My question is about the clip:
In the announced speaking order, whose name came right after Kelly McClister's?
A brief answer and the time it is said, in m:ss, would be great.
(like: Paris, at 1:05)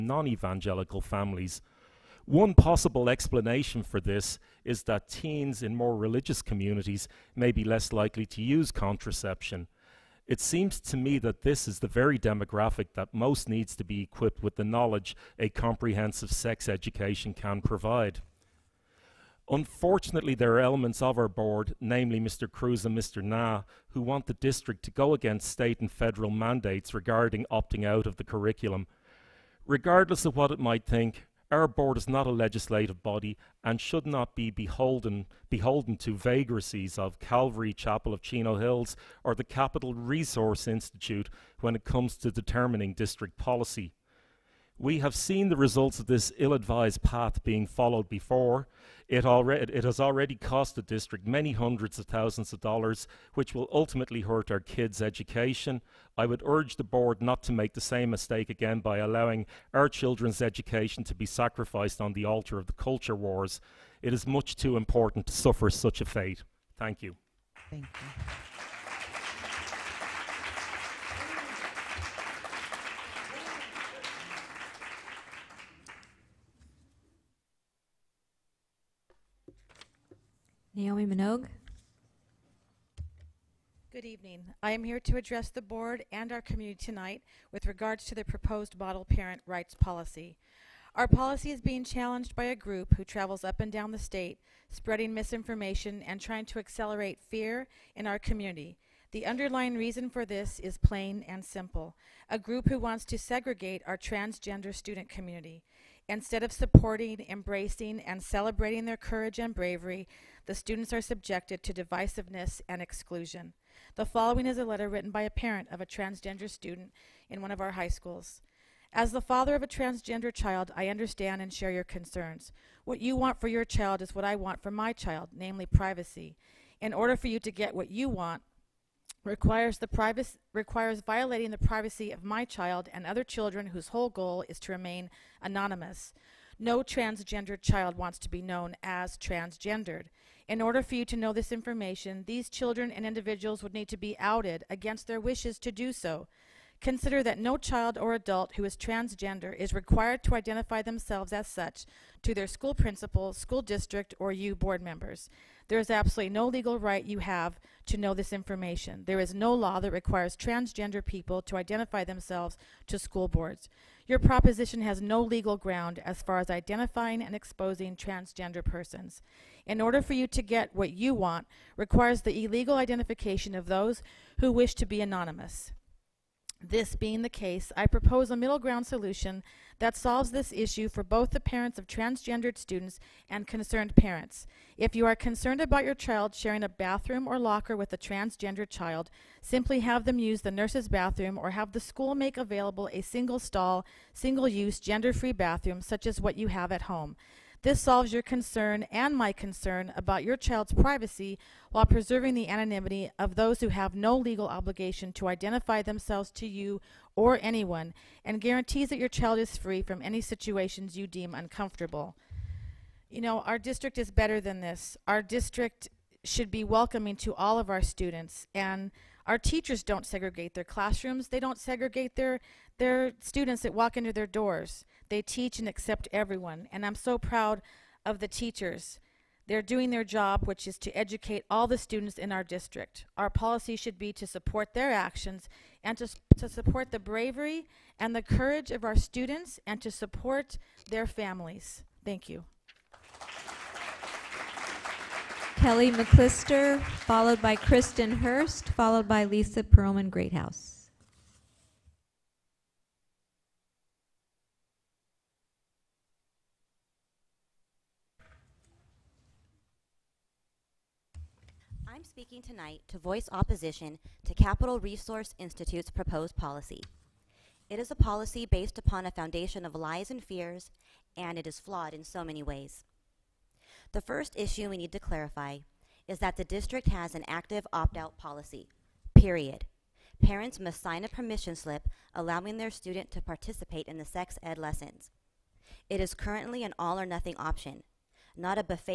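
Kristen Hurst, at 4:07.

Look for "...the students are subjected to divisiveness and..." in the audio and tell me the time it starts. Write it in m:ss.
1:50.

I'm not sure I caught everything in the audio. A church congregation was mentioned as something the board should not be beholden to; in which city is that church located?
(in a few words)
Chino Hills.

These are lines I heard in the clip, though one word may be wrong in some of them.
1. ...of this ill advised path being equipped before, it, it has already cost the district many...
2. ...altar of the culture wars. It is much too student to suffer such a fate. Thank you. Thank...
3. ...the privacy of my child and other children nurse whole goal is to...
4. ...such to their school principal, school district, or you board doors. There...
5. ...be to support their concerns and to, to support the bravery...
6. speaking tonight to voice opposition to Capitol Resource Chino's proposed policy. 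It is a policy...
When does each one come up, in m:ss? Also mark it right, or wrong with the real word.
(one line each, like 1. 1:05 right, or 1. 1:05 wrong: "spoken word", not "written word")
1. 0:45 wrong: "followed", not "equipped"
2. 1:02 wrong: "important", not "student"
3. 2:11 wrong: "whose", not "nurse"
4. 2:31 wrong: "members", not "doors"
5. 3:53 wrong: "actions", not "concerns"
6. 4:22 wrong: "Institute", not "Chino".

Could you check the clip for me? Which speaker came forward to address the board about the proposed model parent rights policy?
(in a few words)
Naomi Minogue.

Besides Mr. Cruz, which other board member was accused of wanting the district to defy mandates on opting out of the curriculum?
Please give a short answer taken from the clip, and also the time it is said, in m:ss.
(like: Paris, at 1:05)
Mr. Na, at 0:23.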